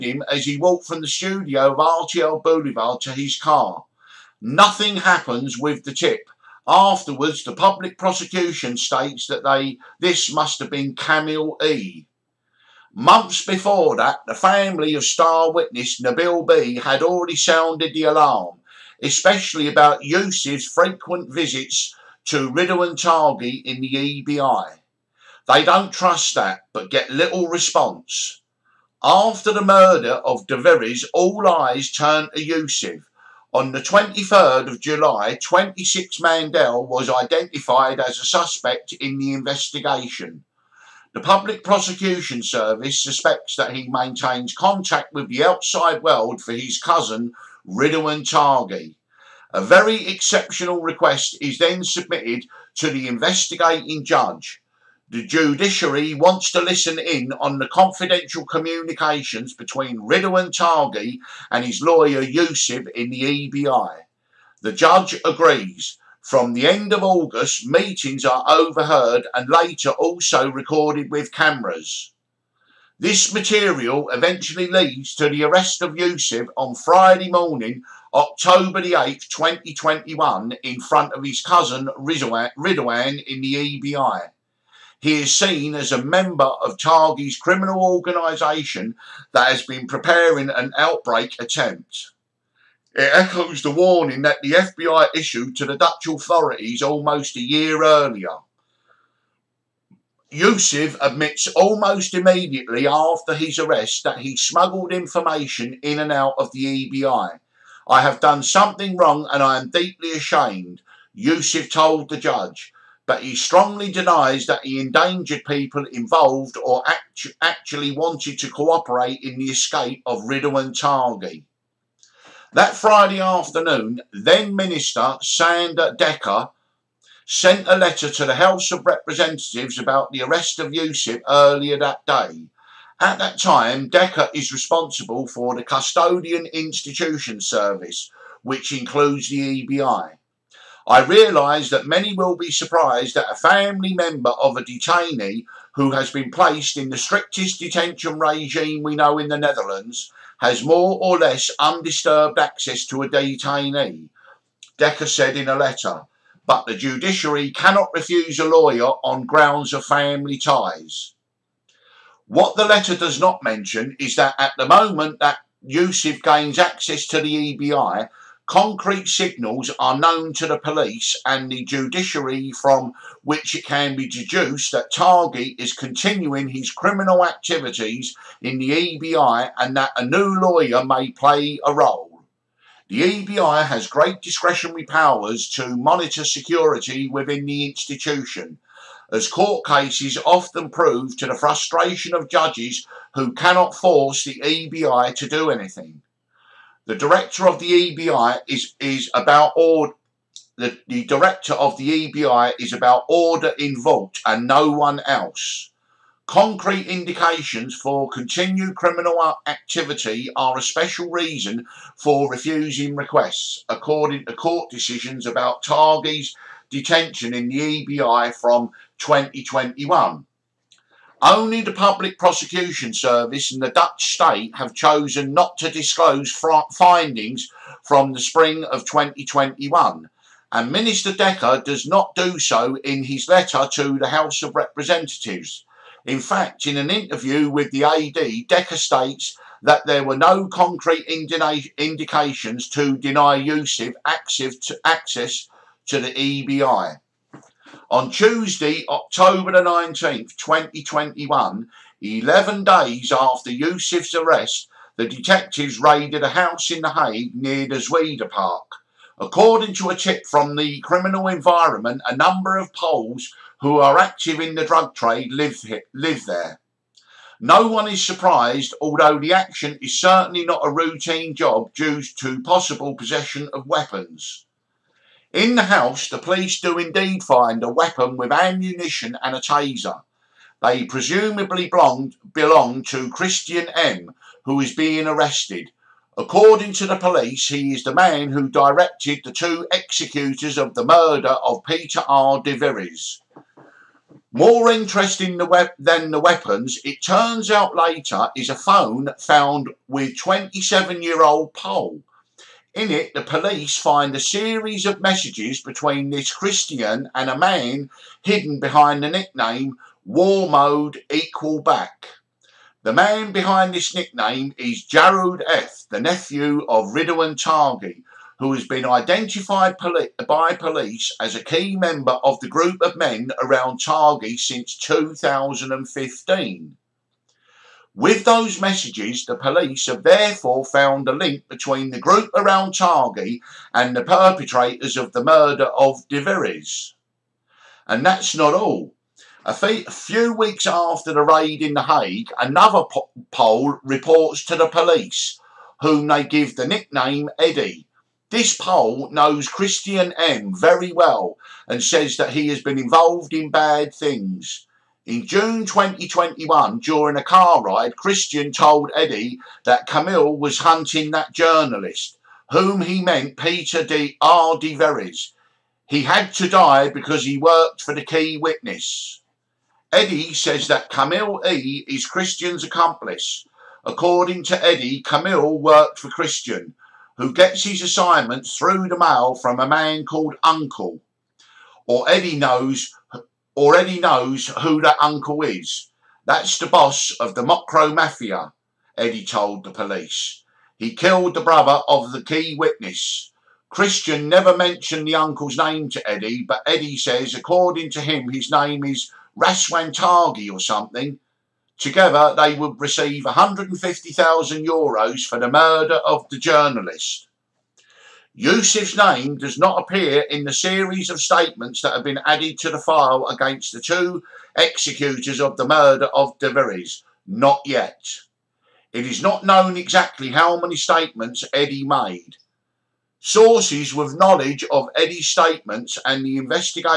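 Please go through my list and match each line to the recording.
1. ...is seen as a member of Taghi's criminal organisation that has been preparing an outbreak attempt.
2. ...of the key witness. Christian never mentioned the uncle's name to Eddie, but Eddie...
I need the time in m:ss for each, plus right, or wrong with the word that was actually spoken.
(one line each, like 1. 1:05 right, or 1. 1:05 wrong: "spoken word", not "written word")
1. 1:25 right
2. 6:31 right.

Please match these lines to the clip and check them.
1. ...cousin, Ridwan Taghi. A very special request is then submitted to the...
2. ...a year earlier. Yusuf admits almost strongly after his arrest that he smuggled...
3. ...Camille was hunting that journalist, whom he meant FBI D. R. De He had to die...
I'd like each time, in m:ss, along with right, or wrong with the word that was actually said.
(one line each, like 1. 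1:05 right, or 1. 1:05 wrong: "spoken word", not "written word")
1. 0:46 wrong: "exceptional", not "special"
2. 1:37 wrong: "immediately", not "strongly"
3. 5:59 wrong: "Peter", not "FBI".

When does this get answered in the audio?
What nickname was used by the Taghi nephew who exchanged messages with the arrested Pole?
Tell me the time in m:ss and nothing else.
5:10.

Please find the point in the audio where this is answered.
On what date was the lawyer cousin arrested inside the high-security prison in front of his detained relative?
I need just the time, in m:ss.
1:18.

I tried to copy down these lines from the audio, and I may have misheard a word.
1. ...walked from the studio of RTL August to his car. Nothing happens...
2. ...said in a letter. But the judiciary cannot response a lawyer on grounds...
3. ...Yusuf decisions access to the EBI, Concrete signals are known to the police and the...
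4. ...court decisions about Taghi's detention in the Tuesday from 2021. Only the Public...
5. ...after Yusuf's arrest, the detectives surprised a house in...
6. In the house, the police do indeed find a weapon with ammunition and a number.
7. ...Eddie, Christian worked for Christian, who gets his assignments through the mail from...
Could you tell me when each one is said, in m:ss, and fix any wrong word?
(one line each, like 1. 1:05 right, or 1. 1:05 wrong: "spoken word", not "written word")
1. 0:00 wrong: "Boulevard", not "August"
2. 2:35 wrong: "refuse", not "response"
3. 2:45 wrong: "gains", not "decisions"
4. 3:34 wrong: "EBI", not "Tuesday"
5. 4:13 wrong: "raided", not "surprised"
6. 4:35 wrong: "taser", not "number"
7. 6:14 wrong: "Camille", not "Christian".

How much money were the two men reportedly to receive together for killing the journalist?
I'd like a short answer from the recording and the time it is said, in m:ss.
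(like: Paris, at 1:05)
150,000 euros, at 6:43.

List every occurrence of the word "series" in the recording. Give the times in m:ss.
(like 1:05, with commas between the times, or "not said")
5:04, 6:50.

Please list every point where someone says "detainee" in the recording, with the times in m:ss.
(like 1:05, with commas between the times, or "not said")
2:24, 2:33.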